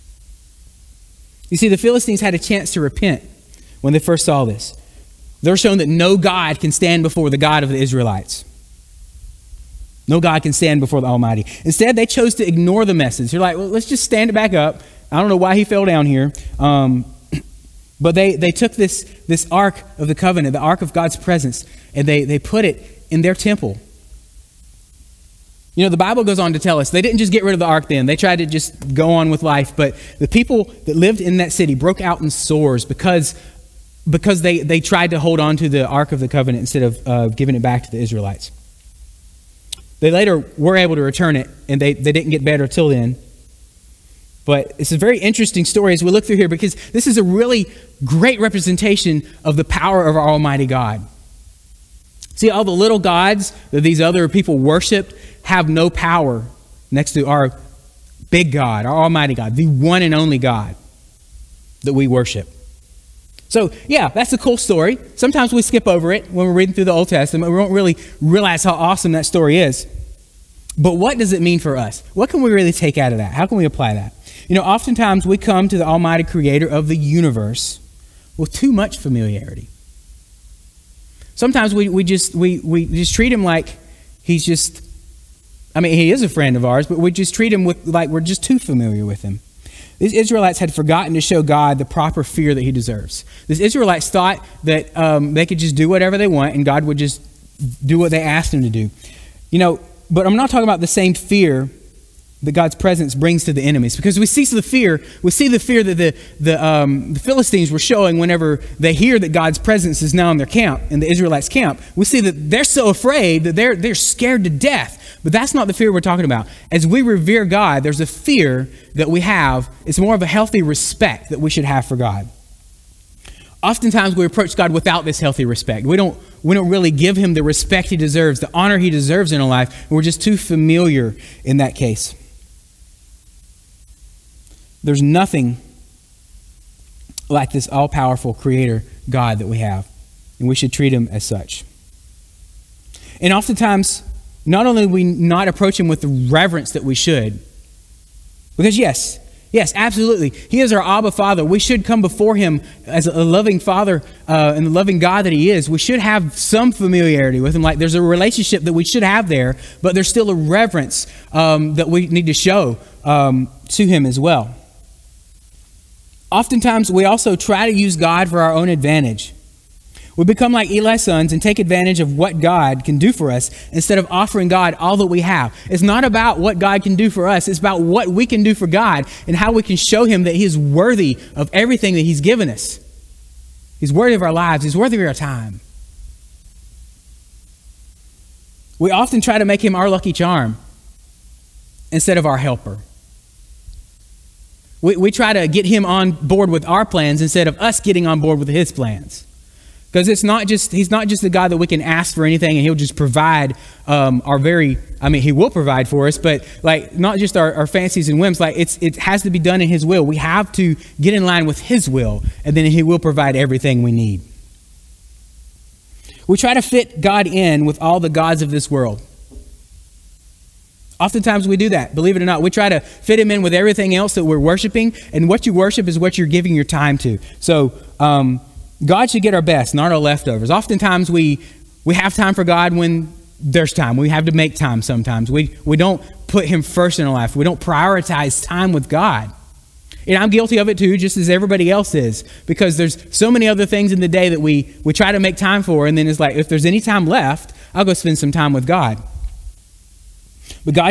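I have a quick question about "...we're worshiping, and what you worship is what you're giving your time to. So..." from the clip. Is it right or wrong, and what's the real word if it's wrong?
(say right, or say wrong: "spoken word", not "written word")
right.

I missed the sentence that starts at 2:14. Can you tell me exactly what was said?
There's nothing like this all powerful creator God that we have, and we should treat him as such.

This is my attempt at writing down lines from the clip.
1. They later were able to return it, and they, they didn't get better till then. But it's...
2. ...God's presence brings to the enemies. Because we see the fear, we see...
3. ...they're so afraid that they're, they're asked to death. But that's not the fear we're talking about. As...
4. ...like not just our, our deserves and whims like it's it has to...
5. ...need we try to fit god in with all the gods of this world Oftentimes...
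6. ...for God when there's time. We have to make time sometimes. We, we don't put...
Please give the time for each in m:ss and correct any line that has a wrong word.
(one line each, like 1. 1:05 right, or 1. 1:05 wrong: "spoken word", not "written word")
1. 0:39 right
2. 1:42 right
3. 1:52 wrong: "scared", not "asked"
4. 3:26 wrong: "fancies", not "deserves"
5. 3:33 right
6. 3:52 right.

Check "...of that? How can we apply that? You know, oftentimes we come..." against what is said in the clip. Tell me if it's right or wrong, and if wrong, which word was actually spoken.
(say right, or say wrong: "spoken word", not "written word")
right.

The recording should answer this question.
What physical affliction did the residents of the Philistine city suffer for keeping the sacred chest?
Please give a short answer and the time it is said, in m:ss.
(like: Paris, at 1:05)
Sores, at 0:32.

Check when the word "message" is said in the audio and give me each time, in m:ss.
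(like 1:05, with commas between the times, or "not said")
0:12.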